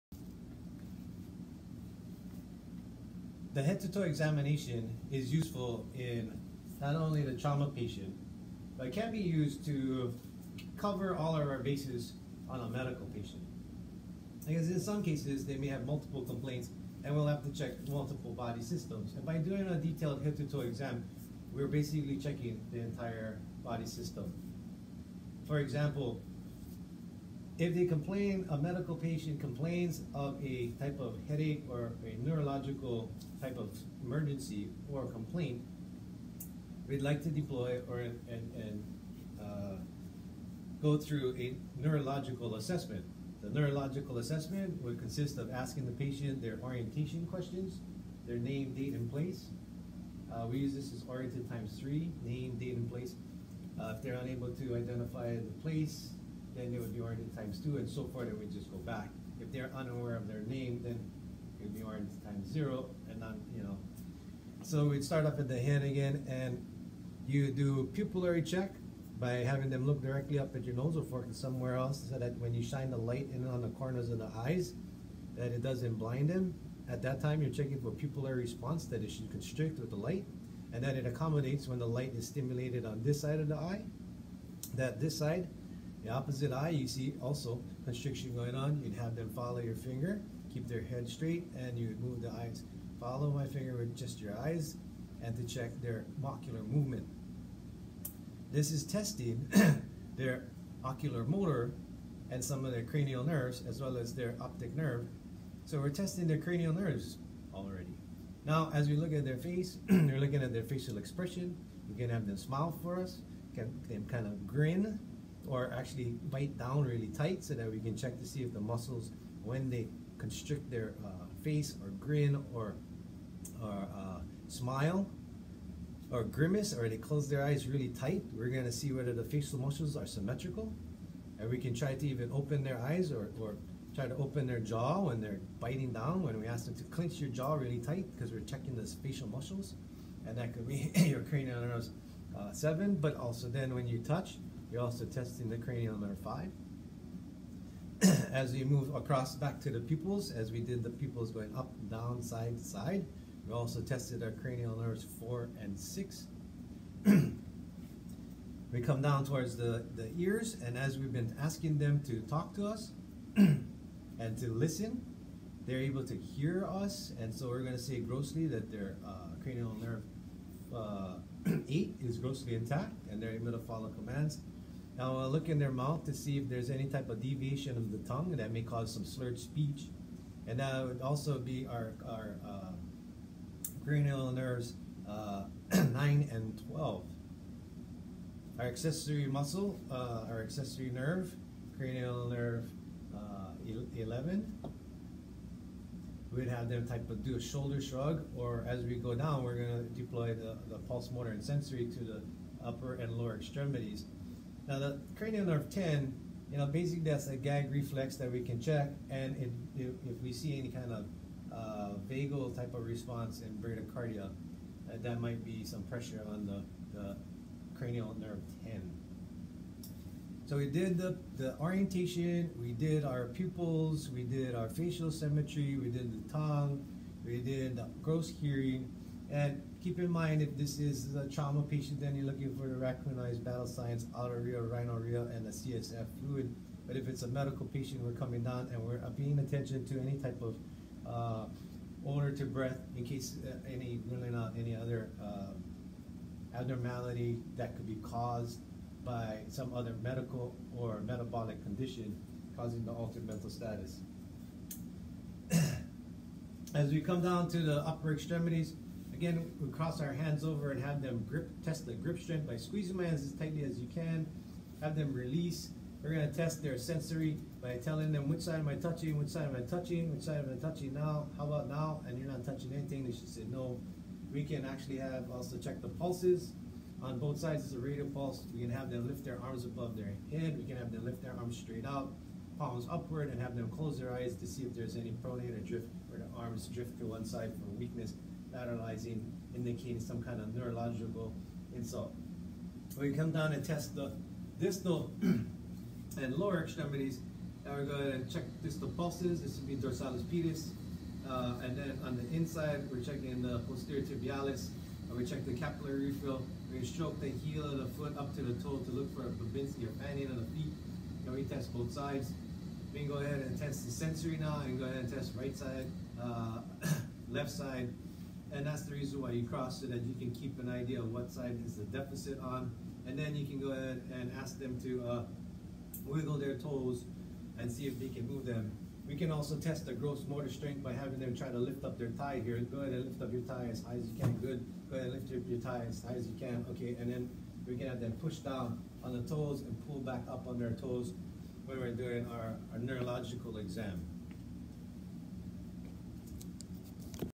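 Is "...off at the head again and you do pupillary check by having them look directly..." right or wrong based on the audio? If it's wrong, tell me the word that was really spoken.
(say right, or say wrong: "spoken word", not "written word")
right.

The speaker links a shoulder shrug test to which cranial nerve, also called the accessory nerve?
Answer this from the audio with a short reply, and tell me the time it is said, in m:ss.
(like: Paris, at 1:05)
11, at 3:13.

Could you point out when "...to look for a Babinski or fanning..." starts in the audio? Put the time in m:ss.
5:08.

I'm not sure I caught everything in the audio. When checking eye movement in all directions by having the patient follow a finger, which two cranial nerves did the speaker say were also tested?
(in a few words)
4 and 6.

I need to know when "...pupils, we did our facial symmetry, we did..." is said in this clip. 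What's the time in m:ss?
3:43.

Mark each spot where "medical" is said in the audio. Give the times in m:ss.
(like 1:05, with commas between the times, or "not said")
0:12, 0:28, 3:57, 4:10.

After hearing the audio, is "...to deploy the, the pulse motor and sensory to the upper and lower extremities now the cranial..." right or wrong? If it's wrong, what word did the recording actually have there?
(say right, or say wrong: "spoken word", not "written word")
right.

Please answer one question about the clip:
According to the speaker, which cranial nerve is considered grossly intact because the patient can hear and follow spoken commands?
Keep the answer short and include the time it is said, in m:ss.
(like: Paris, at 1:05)
8, at 2:51.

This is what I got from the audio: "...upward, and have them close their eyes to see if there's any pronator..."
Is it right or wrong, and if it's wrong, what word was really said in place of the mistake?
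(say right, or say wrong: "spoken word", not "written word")
right.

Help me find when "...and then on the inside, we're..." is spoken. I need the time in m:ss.
5:01.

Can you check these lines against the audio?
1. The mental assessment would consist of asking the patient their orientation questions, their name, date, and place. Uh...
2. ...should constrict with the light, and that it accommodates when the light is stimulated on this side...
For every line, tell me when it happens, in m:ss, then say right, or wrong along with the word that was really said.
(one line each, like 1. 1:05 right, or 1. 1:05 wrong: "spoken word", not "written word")
1. 0:43 wrong: "neurological", not "mental"
2. 1:19 right.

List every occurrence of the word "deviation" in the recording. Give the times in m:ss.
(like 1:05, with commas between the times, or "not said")
2:57.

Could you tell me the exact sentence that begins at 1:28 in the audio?
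You'd have them follow your finger, keep their head straight, and you would move the eyes.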